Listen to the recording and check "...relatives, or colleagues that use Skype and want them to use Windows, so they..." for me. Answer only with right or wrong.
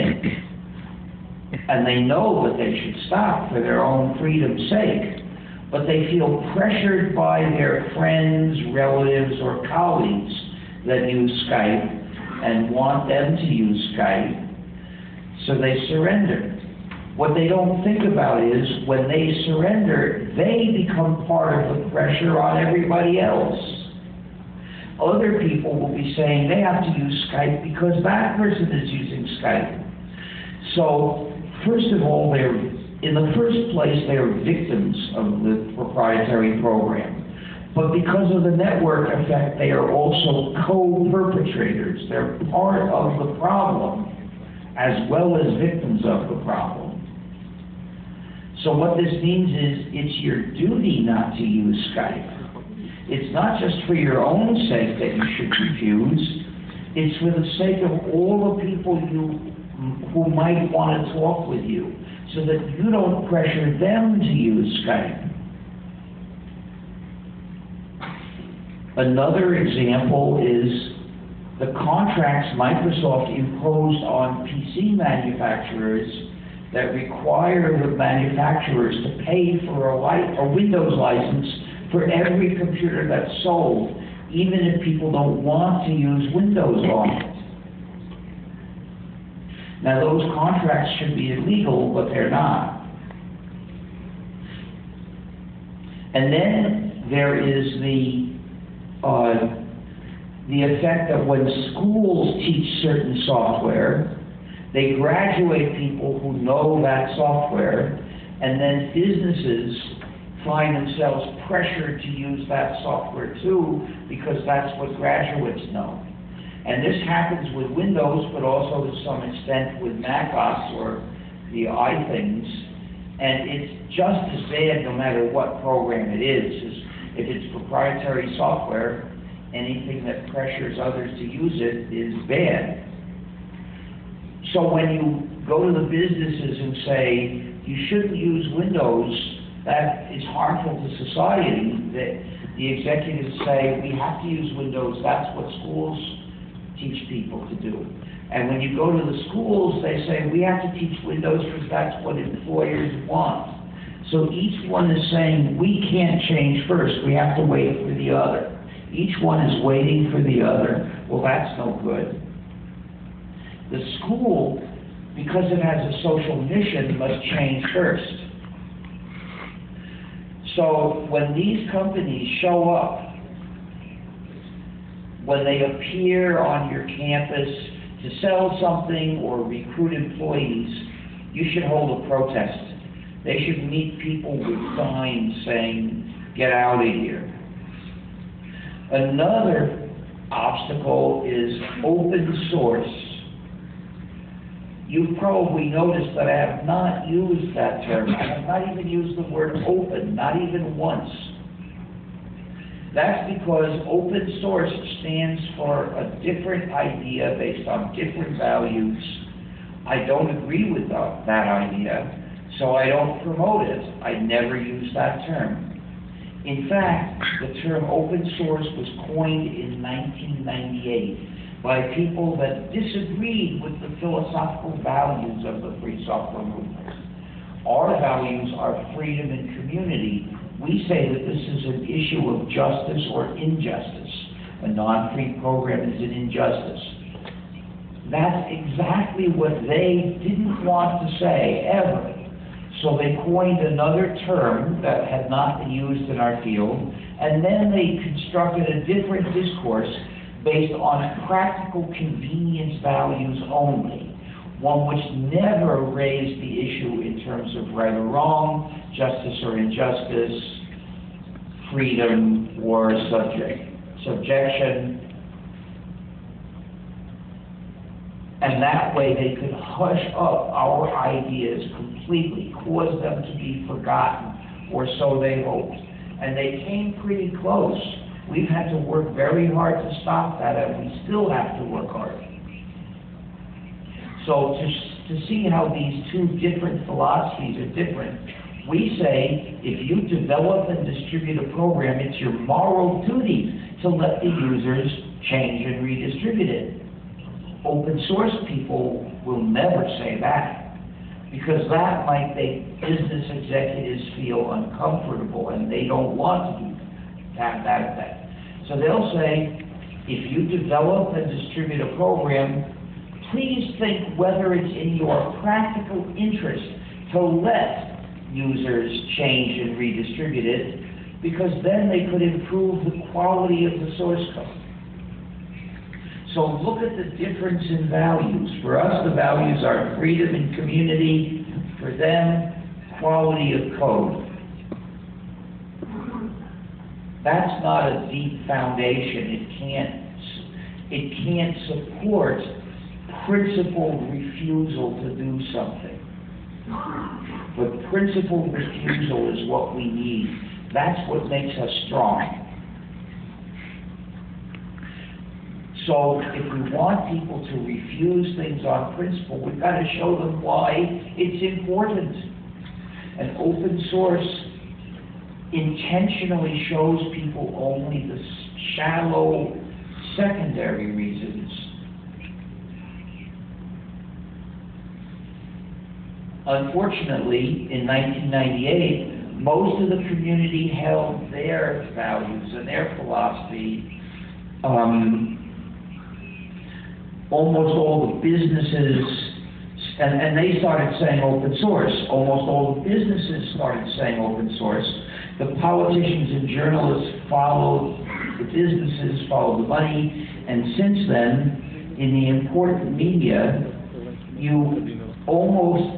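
wrong.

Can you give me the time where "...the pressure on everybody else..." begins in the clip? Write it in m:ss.
0:21.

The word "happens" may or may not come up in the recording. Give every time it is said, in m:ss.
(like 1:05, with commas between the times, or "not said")
1:57.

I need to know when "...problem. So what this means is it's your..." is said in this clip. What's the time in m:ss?
0:46.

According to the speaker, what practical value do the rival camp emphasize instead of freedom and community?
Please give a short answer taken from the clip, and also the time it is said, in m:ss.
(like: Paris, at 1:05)
Quality of code, at 5:33.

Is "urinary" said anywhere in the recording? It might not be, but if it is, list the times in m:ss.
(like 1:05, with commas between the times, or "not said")
not said.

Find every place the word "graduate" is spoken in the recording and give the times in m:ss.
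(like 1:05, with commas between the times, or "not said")
1:44, 1:54.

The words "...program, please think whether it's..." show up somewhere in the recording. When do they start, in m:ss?
5:11.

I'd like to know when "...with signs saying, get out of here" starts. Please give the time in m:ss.
3:04.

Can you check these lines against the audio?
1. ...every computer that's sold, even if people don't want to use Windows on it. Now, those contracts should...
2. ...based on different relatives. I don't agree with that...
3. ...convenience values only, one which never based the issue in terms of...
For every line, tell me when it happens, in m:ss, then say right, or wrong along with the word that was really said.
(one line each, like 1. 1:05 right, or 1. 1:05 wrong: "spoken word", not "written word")
1. 1:22 right
2. 3:27 wrong: "values", not "relatives"
3. 4:11 wrong: "raised", not "based".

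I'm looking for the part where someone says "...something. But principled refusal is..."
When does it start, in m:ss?
5:45.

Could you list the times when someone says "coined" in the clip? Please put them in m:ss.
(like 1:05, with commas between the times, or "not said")
3:39, 4:03.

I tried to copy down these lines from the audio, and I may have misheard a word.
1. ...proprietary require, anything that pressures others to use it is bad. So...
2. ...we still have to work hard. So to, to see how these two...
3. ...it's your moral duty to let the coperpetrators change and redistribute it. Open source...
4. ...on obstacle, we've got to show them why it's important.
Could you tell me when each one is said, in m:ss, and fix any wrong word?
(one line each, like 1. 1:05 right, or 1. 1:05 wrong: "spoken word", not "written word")
1. 2:07 wrong: "software", not "require"
2. 4:40 right
3. 4:51 wrong: "users", not "coperpetrators"
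4. 5:58 wrong: "principle", not "obstacle".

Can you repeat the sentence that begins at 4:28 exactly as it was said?
And that way they could hush up our ideas completely, cause them to be forgotten, or so they hoped.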